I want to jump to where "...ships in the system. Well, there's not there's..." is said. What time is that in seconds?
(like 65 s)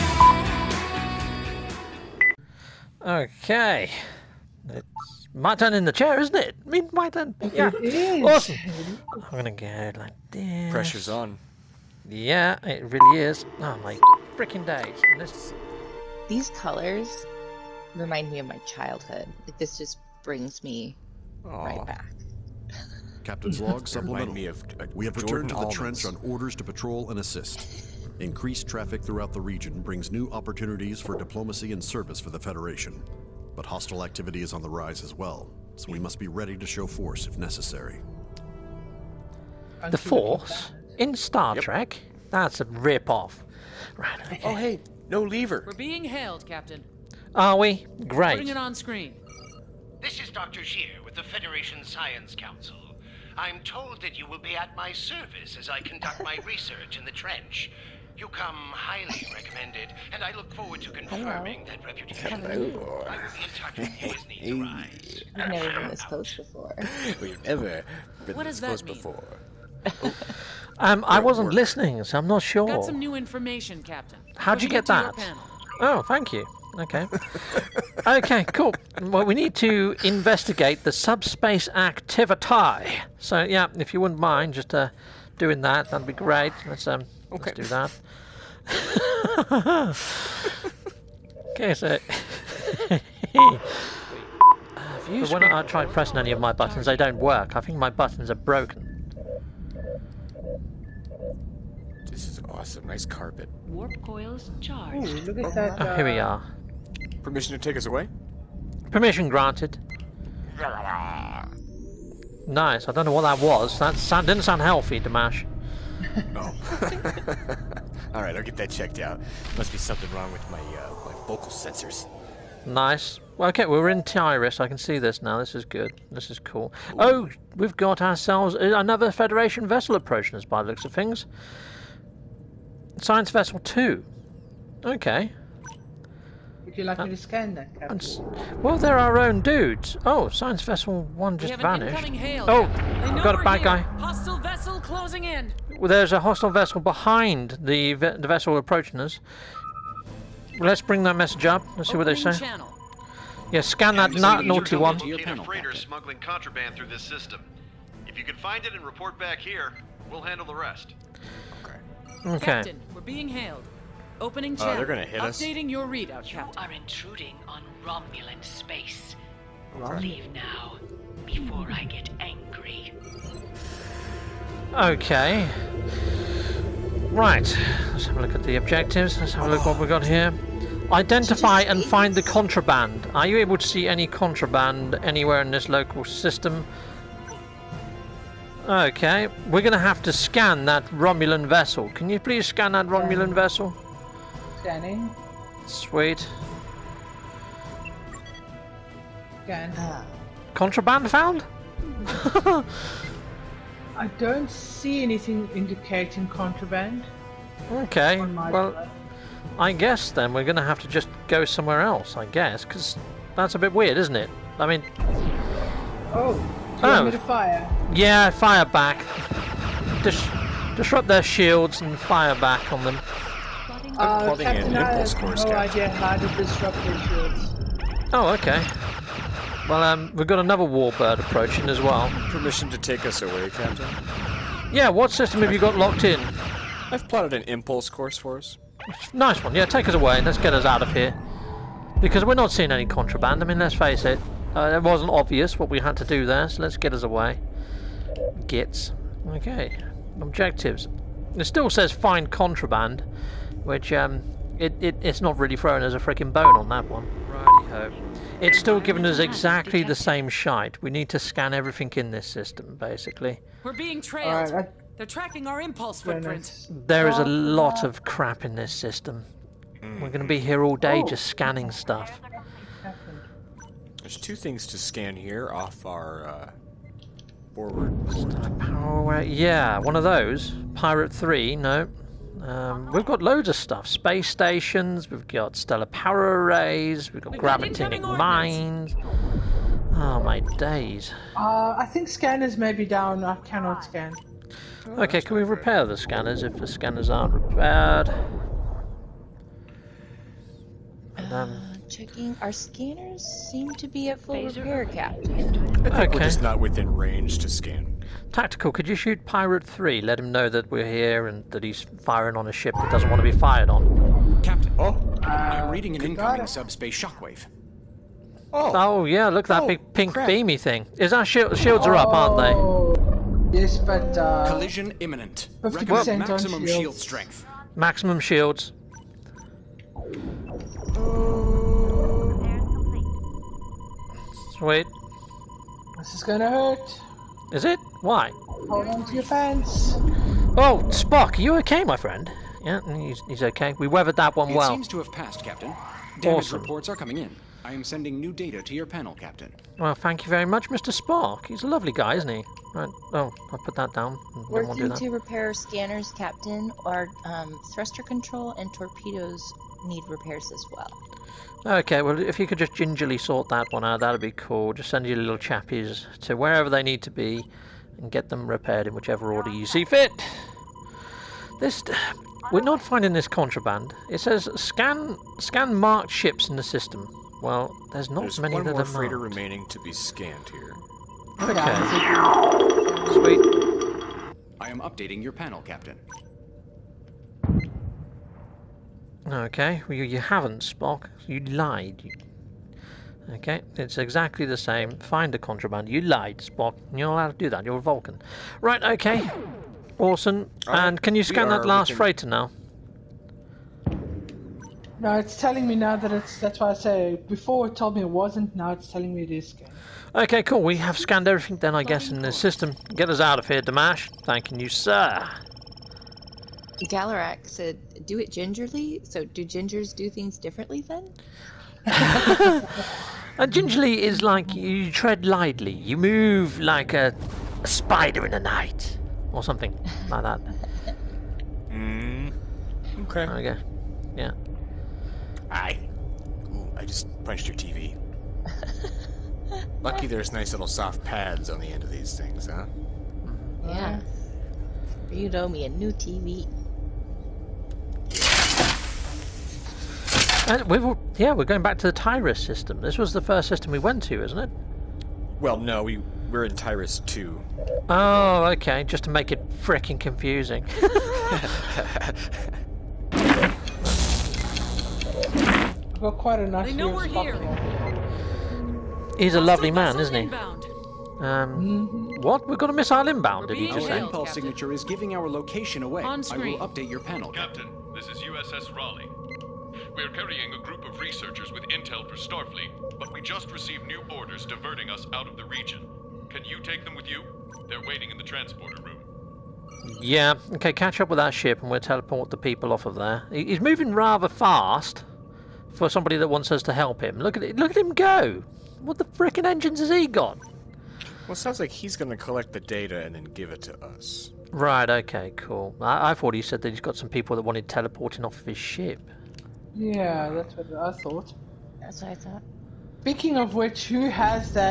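376 s.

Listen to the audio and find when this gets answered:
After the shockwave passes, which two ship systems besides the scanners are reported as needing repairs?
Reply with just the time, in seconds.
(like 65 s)
357 s.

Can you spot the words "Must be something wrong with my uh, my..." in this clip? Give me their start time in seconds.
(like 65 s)
119 s.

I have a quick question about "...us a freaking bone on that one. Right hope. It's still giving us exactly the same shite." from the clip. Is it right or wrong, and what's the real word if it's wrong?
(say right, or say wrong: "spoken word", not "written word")
right.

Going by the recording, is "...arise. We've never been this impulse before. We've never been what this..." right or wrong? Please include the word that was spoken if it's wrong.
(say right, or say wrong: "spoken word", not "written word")
wrong: "close", not "impulse".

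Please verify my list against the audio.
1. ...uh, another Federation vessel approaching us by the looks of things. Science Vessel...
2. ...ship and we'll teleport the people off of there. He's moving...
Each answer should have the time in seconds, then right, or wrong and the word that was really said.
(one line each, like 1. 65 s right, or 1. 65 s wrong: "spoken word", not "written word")
1. 128 s right
2. 491 s right.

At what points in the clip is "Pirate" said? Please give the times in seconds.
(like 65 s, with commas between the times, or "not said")
280 s, 309 s.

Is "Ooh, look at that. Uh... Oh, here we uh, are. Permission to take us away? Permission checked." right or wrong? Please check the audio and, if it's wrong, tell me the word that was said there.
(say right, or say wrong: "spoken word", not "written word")
wrong: "granted", not "checked".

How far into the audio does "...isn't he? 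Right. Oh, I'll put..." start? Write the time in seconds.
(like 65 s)
352 s.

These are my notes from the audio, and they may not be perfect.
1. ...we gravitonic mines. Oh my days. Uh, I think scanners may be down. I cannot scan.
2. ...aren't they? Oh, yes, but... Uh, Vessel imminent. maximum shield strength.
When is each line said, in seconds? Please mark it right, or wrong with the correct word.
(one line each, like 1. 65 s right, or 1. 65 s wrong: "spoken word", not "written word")
1. 287 s right
2. 322 s wrong: "Collision", not "Vessel".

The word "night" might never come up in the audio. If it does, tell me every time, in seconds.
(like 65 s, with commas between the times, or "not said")
428 s.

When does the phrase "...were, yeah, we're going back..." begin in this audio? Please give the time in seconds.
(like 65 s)
450 s.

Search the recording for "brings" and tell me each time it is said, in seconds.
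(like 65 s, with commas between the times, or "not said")
20 s, 29 s, 150 s.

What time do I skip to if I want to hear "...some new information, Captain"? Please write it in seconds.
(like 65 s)
72 s.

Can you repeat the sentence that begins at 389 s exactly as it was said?
Okay, well, you, you haven't, Spock.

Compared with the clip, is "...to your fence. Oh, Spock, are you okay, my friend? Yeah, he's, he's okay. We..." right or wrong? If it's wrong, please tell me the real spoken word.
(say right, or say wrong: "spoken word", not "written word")
right.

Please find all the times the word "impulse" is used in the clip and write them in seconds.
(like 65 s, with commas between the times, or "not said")
237 s, 265 s, 473 s.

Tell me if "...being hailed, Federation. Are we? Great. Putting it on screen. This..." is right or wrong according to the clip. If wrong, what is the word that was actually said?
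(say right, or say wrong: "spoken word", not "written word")
wrong: "Captain", not "Federation".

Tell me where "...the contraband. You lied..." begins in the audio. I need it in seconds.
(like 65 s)
395 s.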